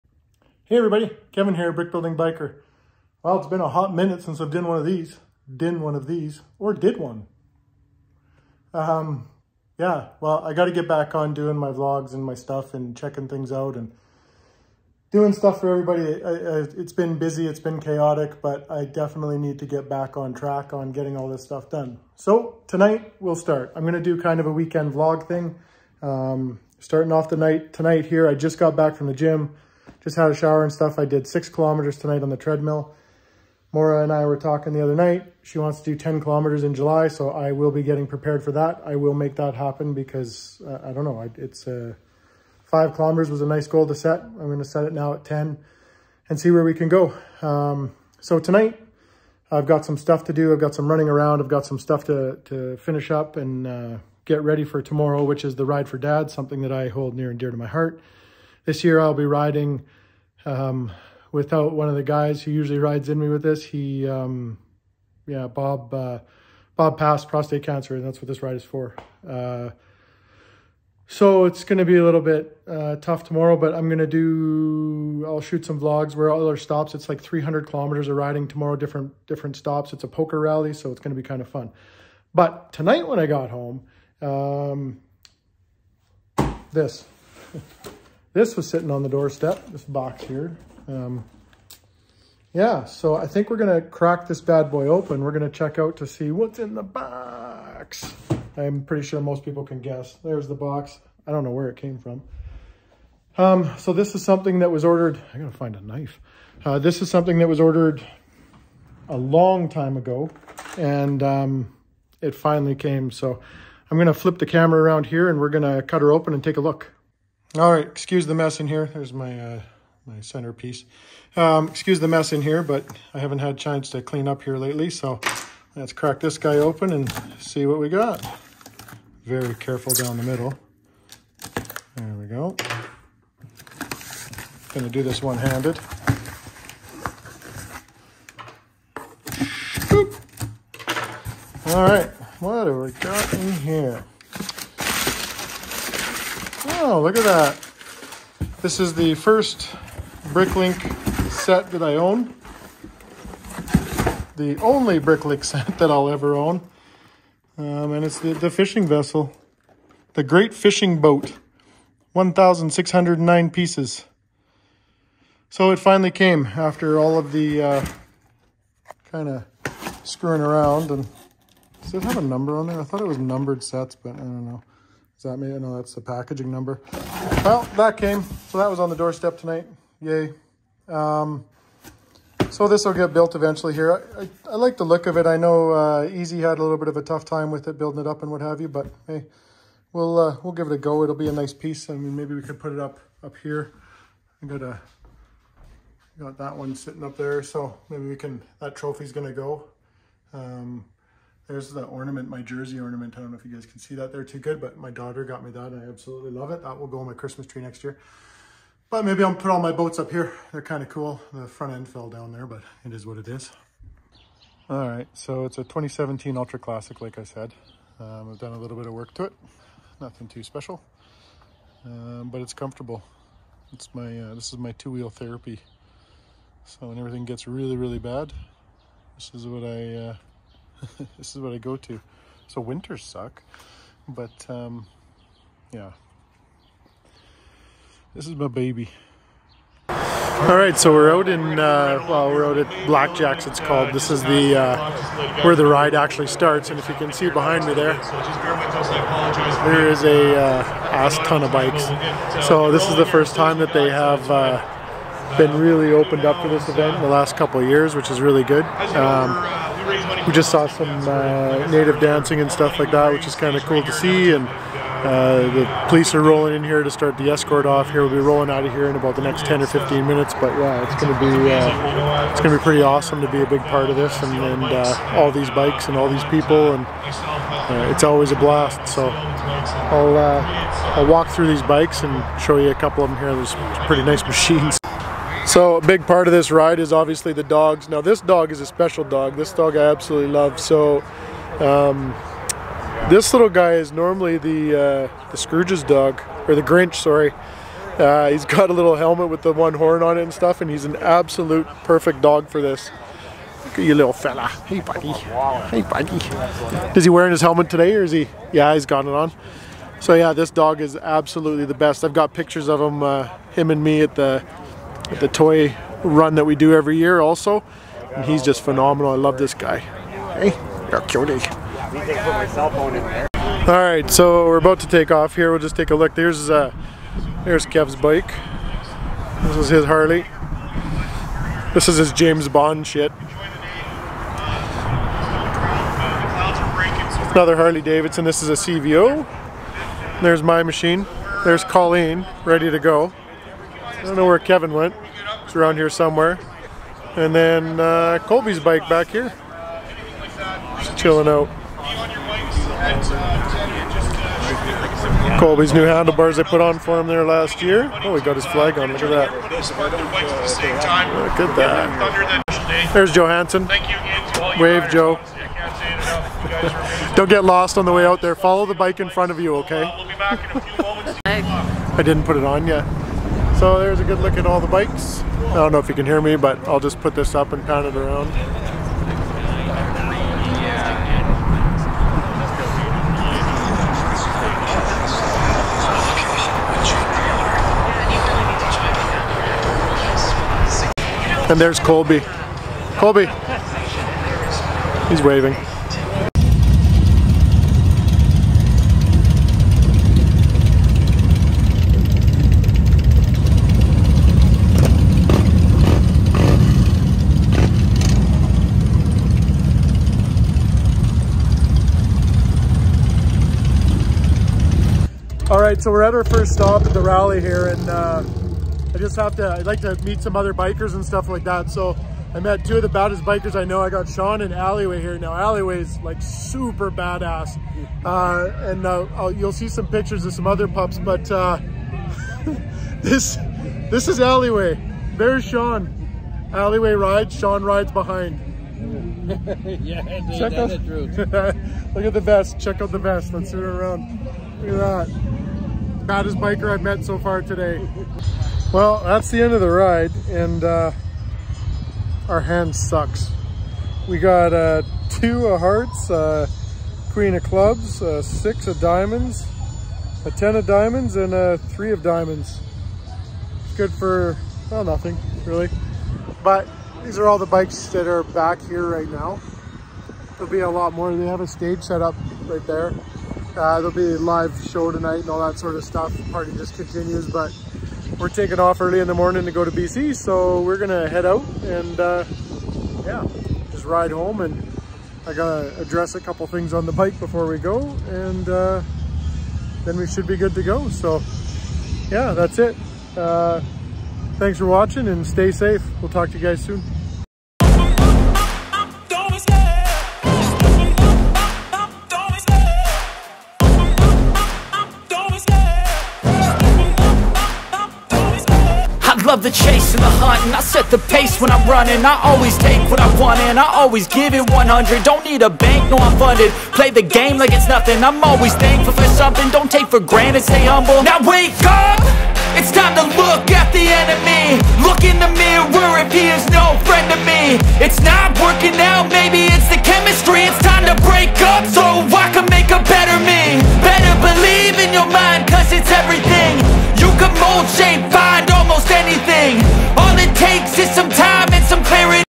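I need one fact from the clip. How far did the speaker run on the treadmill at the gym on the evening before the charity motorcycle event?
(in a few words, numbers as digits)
6 kilometers.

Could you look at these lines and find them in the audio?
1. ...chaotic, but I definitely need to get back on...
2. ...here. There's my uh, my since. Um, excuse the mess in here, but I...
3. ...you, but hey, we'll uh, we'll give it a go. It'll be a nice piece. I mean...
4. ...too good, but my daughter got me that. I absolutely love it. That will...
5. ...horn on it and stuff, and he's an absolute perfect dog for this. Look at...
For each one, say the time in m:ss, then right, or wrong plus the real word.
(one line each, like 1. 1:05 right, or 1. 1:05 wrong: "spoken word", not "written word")
1. 0:17 right
2. 1:58 wrong: "centerpiece", not "since"
3. 3:08 right
4. 3:24 right
5. 4:59 right.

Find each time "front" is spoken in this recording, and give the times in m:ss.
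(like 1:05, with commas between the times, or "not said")
3:31, 6:09.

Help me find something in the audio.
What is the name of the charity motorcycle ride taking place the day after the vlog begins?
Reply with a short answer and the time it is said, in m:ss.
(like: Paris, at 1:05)
Ride for Dad, at 0:55.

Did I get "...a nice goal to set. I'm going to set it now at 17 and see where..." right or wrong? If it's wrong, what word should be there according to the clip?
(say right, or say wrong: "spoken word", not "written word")
wrong: "10", not "17".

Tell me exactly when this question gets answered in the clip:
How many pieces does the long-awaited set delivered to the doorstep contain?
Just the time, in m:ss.
2:42.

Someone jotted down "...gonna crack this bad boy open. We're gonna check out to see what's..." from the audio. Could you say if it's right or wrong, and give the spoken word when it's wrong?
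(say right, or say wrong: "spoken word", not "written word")
right.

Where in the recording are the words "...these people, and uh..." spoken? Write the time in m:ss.
4:36.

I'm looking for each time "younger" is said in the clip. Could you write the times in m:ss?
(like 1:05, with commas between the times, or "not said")
not said.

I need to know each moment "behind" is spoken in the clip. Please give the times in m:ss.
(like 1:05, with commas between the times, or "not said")
4:07, 7:17.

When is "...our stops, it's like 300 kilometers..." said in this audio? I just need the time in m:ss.
1:16.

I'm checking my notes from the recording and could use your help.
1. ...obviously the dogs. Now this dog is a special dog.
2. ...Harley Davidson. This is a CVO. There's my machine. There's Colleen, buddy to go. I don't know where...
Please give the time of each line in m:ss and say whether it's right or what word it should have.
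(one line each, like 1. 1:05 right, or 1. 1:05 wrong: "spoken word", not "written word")
1. 4:46 right
2. 5:37 wrong: "ready", not "buddy".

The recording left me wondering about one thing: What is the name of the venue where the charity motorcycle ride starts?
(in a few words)
Blackjack's.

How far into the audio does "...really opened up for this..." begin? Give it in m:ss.
4:15.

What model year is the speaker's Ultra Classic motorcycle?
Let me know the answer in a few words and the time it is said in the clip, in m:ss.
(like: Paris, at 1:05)
2017, at 3:35.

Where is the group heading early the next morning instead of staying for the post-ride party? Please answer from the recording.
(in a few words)
BC.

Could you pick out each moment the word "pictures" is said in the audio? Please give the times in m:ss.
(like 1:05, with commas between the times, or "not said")
5:12, 7:09.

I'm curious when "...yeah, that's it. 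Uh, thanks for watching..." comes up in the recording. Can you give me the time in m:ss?
8:12.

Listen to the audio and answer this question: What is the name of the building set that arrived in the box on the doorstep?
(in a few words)
The Great Fishing Boat.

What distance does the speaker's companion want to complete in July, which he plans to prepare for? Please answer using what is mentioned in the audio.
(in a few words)
10 kilometers.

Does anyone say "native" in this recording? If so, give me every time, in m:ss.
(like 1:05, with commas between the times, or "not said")
4:21.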